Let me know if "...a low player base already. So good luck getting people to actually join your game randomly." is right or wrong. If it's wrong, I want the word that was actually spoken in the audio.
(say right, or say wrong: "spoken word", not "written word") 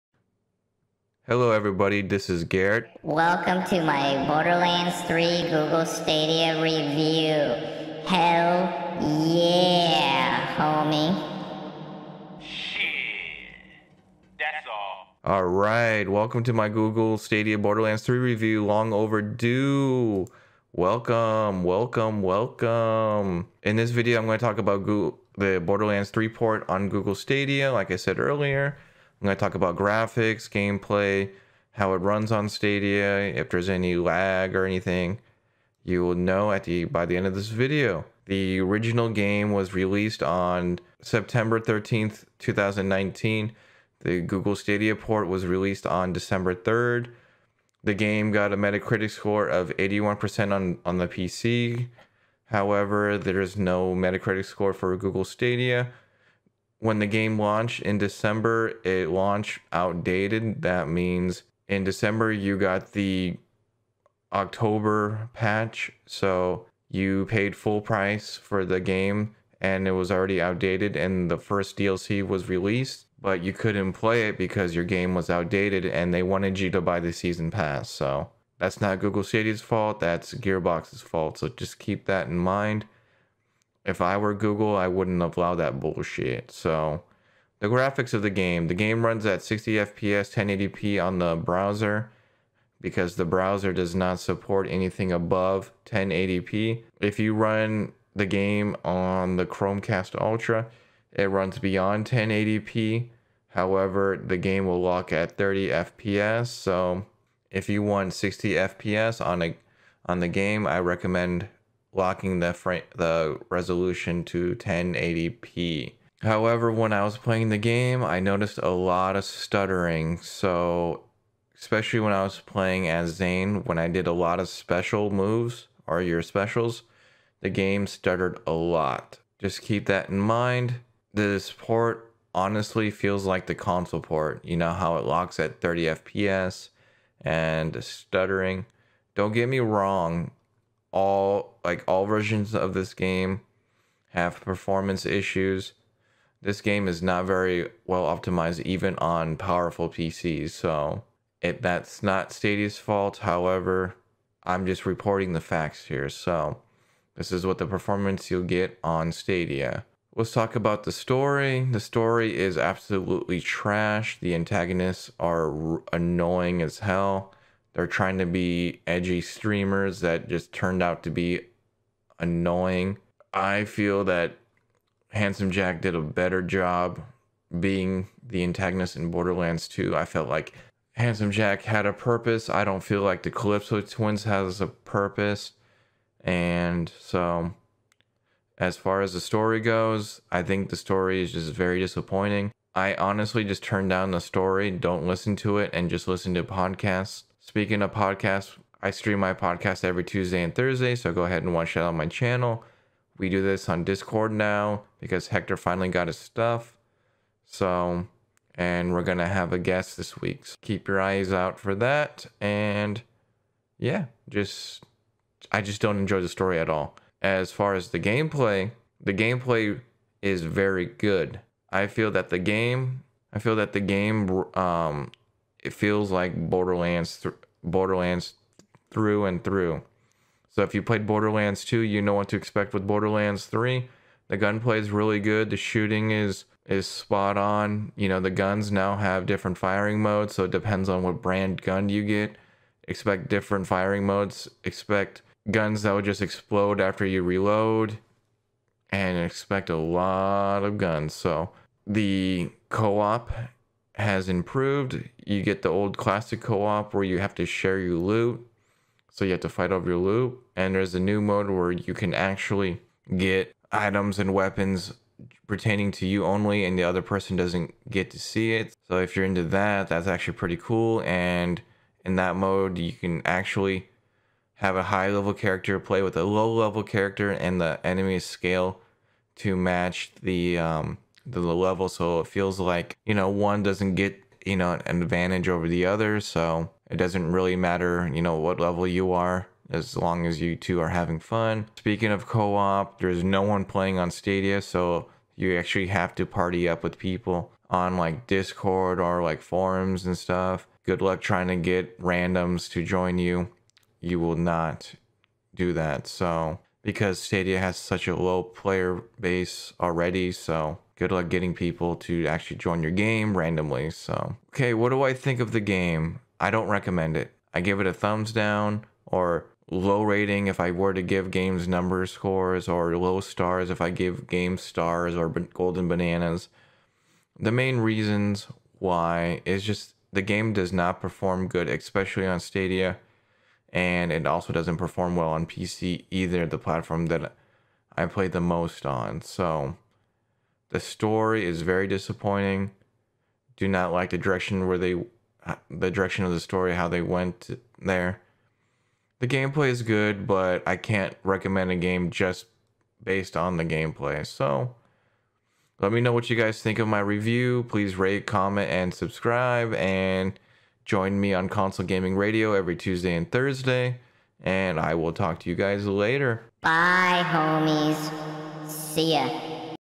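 right.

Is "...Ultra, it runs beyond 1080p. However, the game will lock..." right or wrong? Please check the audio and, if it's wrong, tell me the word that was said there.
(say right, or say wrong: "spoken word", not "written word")
right.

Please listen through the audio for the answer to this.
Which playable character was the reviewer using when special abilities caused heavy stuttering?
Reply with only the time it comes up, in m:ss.
2:03.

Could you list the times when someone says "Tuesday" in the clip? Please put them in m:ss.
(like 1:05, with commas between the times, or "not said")
3:20, 6:02.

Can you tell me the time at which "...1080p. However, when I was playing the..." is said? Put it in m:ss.
1:54.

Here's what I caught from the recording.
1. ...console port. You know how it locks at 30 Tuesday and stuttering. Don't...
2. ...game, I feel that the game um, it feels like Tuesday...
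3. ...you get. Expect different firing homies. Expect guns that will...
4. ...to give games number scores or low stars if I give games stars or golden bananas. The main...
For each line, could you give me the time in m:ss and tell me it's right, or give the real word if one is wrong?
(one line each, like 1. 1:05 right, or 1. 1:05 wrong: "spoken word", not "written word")
1. 2:13 wrong: "FPS", not "Tuesday"
2. 3:42 wrong: "Borderlands", not "Tuesday"
3. 4:01 wrong: "modes", not "homies"
4. 5:20 right.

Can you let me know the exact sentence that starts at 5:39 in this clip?
So the story is very disappointing.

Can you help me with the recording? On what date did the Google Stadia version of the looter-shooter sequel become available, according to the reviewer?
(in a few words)
December 3rd.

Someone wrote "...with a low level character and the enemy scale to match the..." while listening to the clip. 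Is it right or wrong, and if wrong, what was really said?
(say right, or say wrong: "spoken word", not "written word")
right.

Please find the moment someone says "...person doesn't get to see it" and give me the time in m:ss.
4:27.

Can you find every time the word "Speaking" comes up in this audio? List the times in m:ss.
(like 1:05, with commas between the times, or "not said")
3:17, 4:51.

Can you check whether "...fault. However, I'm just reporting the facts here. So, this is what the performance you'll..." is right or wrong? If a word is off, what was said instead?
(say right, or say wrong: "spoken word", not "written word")
right.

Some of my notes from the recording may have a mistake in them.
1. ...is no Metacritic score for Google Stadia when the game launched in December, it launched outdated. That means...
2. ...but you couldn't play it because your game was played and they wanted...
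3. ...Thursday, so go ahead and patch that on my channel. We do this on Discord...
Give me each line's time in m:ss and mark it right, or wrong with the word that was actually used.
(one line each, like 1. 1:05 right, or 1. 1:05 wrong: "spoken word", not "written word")
1. 0:53 right
2. 1:13 wrong: "outdated", not "played"
3. 3:20 wrong: "watch", not "patch".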